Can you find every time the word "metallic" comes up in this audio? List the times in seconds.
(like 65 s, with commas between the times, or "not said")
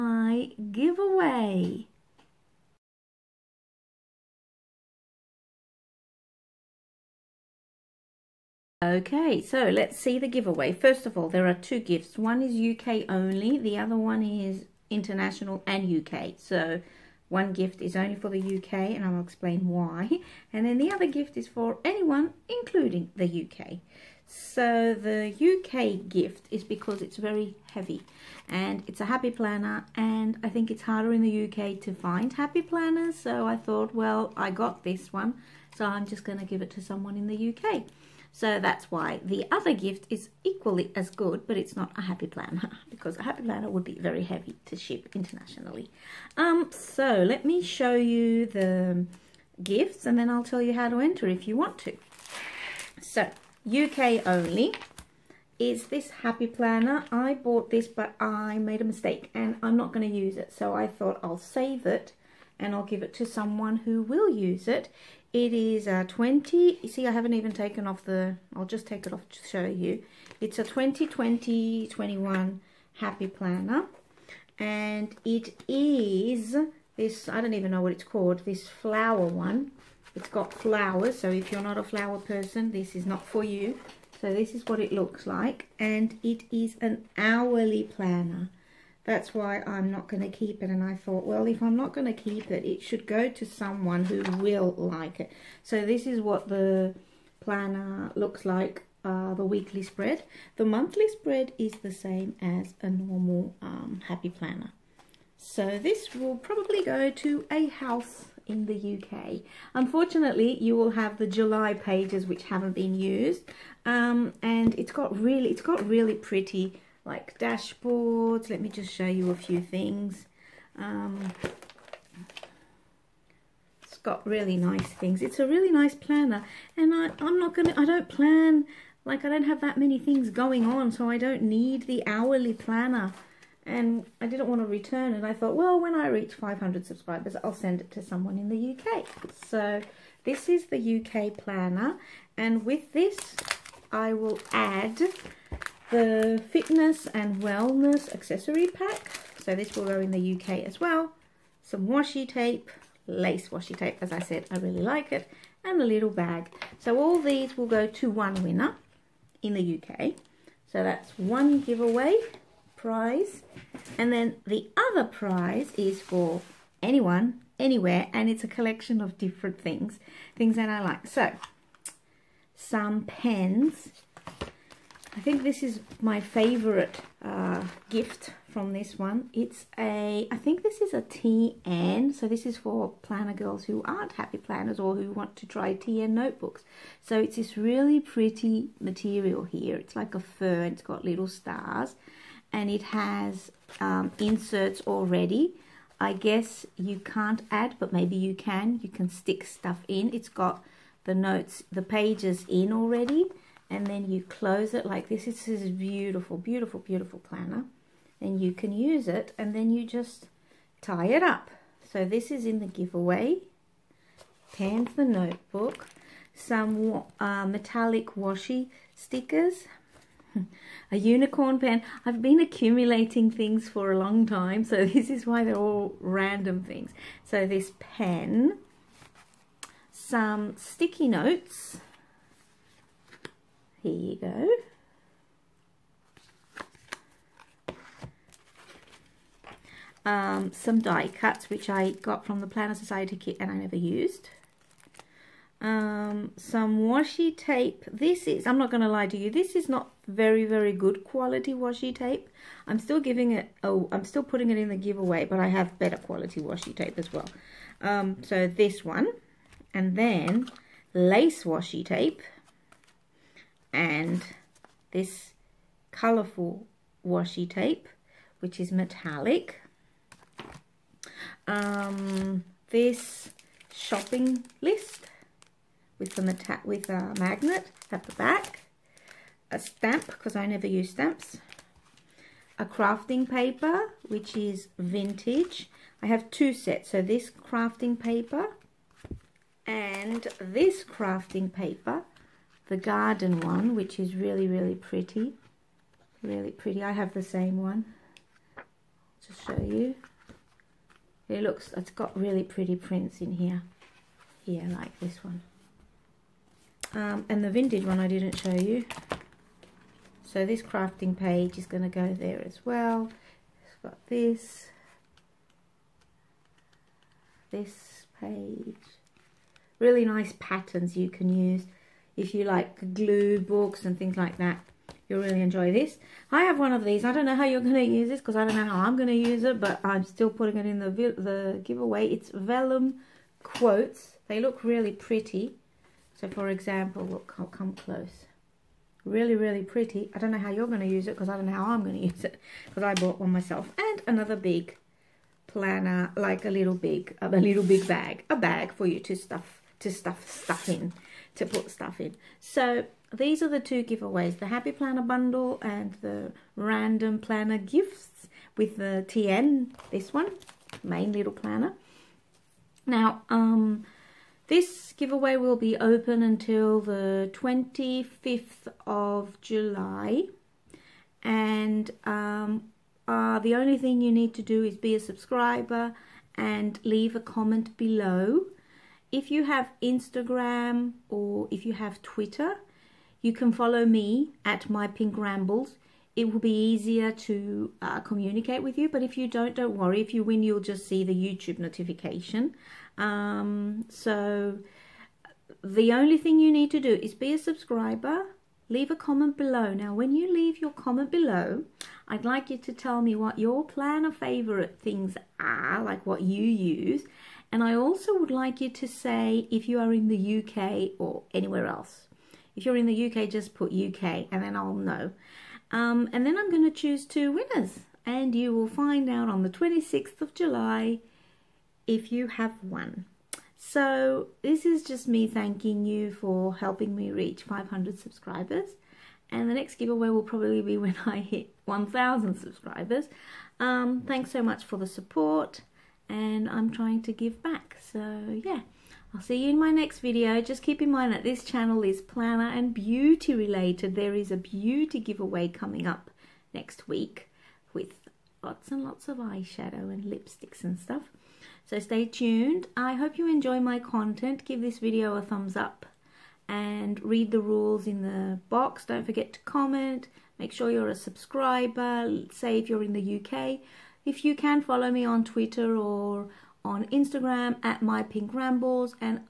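217 s, 268 s.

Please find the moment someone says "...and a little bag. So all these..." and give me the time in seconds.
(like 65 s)
155 s.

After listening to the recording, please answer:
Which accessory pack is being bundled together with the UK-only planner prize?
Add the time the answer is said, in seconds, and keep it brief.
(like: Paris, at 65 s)
fitness and wellness, at 146 s.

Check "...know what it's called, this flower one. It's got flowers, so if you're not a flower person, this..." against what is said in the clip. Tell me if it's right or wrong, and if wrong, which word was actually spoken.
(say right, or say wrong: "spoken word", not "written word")
right.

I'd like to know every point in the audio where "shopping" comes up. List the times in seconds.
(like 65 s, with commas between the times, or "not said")
273 s.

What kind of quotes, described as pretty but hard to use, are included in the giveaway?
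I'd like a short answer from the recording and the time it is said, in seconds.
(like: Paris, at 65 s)
vellum quotes, at 332 s.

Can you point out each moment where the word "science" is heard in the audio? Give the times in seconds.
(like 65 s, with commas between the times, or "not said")
not said.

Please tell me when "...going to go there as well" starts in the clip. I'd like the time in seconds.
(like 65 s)
311 s.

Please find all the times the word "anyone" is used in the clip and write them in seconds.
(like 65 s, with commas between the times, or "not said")
21 s, 166 s.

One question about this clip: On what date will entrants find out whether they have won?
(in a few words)
26th of July.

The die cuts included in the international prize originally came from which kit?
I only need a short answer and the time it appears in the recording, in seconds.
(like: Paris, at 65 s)
Planner Society kit, at 242 s.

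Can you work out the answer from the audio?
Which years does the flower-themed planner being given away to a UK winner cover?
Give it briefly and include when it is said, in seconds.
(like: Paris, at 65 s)
2020-21, at 70 s.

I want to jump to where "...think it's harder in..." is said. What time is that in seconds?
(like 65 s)
30 s.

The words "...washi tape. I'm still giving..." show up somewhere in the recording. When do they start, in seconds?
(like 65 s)
251 s.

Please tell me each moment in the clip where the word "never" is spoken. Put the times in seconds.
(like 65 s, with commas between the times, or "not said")
243 s, 280 s.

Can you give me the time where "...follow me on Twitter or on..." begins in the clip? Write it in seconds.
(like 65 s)
464 s.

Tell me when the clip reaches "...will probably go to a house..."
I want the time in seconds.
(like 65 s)
106 s.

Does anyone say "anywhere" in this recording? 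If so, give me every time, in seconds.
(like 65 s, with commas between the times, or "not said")
167 s, 411 s.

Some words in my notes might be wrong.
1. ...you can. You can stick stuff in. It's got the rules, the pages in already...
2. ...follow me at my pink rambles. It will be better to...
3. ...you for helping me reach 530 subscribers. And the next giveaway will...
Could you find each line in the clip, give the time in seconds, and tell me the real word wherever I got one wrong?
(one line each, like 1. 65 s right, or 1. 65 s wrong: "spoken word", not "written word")
1. 198 s wrong: "notes", not "rules"
2. 383 s wrong: "easier", not "better"
3. 425 s wrong: "500", not "530".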